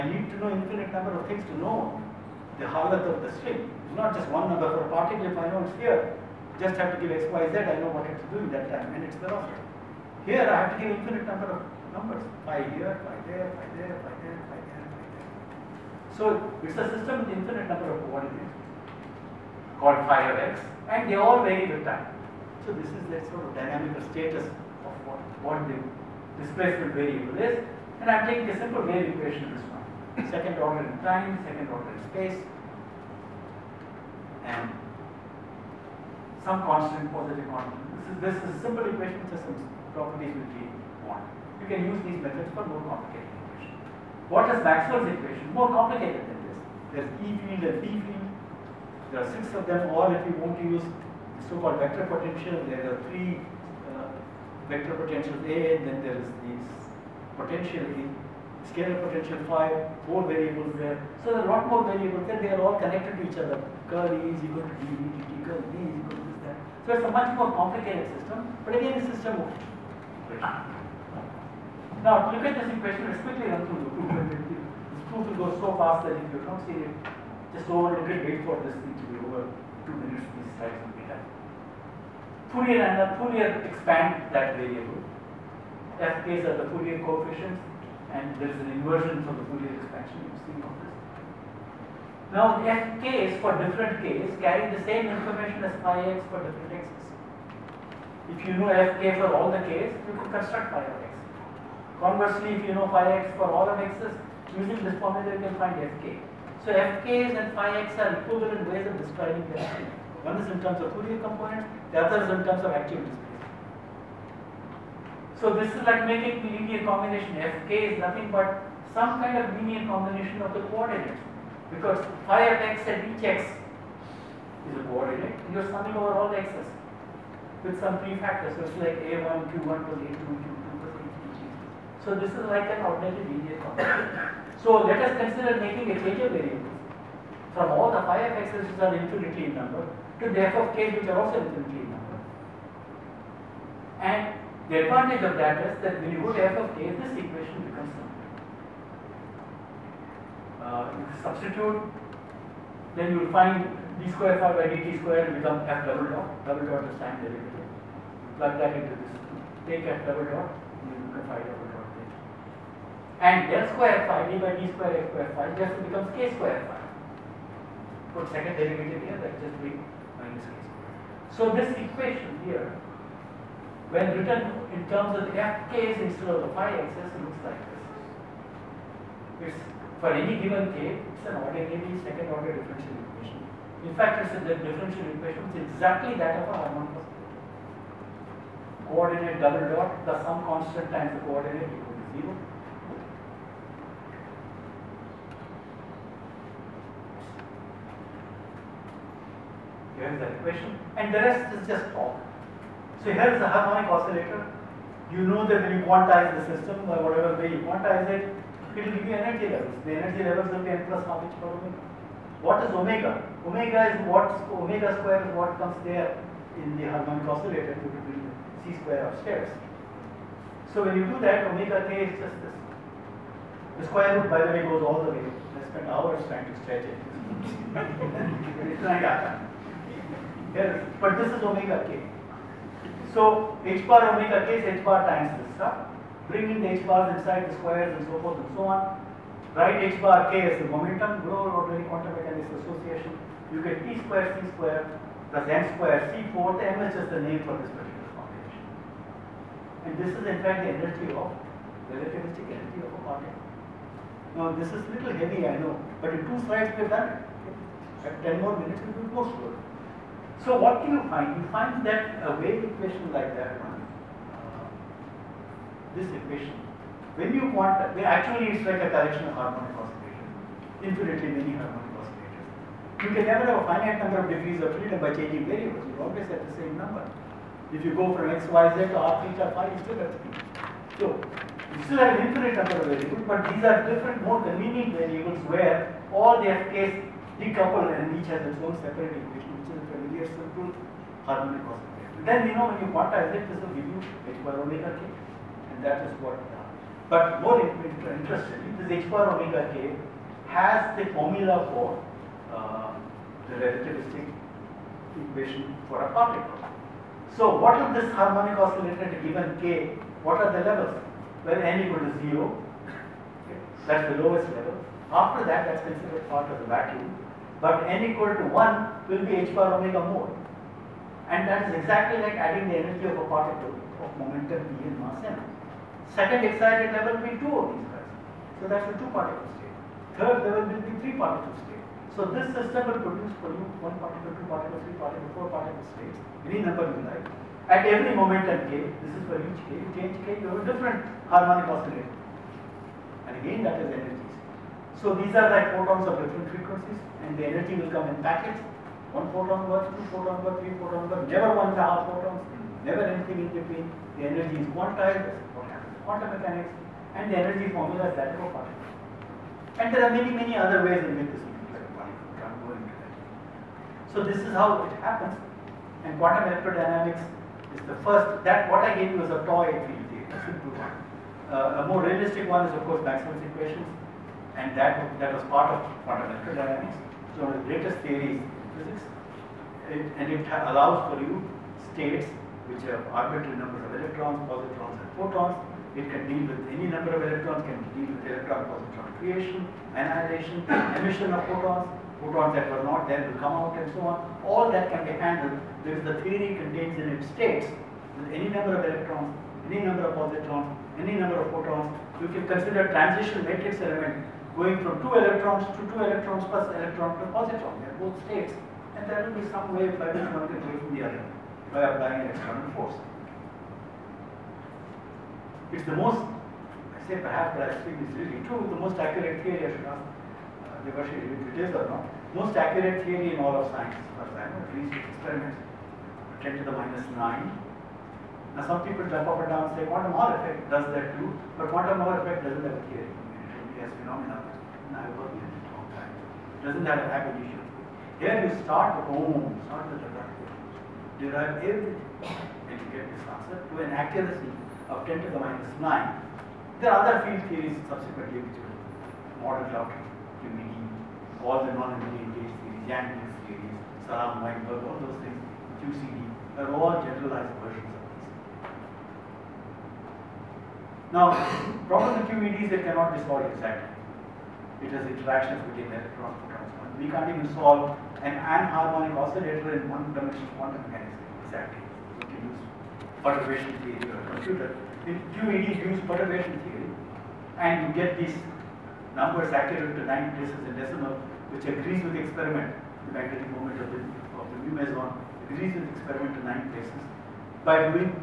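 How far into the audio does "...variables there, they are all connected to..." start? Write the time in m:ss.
1:01.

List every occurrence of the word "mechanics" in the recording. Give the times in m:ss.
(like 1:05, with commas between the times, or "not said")
4:02, 5:56, 7:50.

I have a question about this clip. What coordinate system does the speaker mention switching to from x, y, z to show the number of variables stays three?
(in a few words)
r, theta, phi.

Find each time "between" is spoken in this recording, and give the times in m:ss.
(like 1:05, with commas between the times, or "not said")
5:53, 7:45.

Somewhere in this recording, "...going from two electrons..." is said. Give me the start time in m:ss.
6:44.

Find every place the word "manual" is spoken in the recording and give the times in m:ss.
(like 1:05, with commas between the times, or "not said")
not said.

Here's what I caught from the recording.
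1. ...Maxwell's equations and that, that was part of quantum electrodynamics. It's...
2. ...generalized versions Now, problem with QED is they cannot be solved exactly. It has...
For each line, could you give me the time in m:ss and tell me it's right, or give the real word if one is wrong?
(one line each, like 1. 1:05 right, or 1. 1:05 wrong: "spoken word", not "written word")
1. 6:13 right
2. 7:37 right.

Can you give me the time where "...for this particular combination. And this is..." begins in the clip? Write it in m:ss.
4:07.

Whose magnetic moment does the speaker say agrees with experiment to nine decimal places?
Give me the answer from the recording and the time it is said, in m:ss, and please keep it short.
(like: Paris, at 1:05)
Mu meson, at 8:04.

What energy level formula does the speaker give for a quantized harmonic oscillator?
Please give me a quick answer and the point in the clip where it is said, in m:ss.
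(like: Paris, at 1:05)
n plus half h bar omega, at 3:30.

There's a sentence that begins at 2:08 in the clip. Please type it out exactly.
So it's like a1, q1 plus a2, q2 plus a3, So this is like an ordered linear combination.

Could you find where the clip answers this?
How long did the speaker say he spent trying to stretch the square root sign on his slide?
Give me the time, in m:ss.
3:45.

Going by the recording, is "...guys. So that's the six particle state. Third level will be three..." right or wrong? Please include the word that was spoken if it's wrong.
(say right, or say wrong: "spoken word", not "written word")
wrong: "two", not "six".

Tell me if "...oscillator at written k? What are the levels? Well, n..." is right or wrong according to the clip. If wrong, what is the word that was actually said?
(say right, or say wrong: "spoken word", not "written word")
wrong: "given", not "written".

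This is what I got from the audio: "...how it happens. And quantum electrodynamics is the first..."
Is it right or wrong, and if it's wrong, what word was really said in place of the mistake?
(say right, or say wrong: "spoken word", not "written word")
right.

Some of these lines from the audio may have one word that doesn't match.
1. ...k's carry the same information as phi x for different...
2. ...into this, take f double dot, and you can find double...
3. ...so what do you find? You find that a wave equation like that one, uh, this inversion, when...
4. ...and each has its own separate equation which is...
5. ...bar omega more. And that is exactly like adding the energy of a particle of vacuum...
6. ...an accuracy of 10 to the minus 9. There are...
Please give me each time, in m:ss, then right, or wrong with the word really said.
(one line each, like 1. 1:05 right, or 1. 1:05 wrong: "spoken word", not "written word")
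1. 1:34 right
2. 2:38 right
3. 4:20 wrong: "equation", not "inversion"
4. 4:47 right
5. 5:19 wrong: "momentum", not "vacuum"
6. 7:23 right.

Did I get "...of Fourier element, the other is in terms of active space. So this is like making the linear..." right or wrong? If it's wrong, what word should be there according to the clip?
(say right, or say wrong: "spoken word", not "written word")
wrong: "component", not "element".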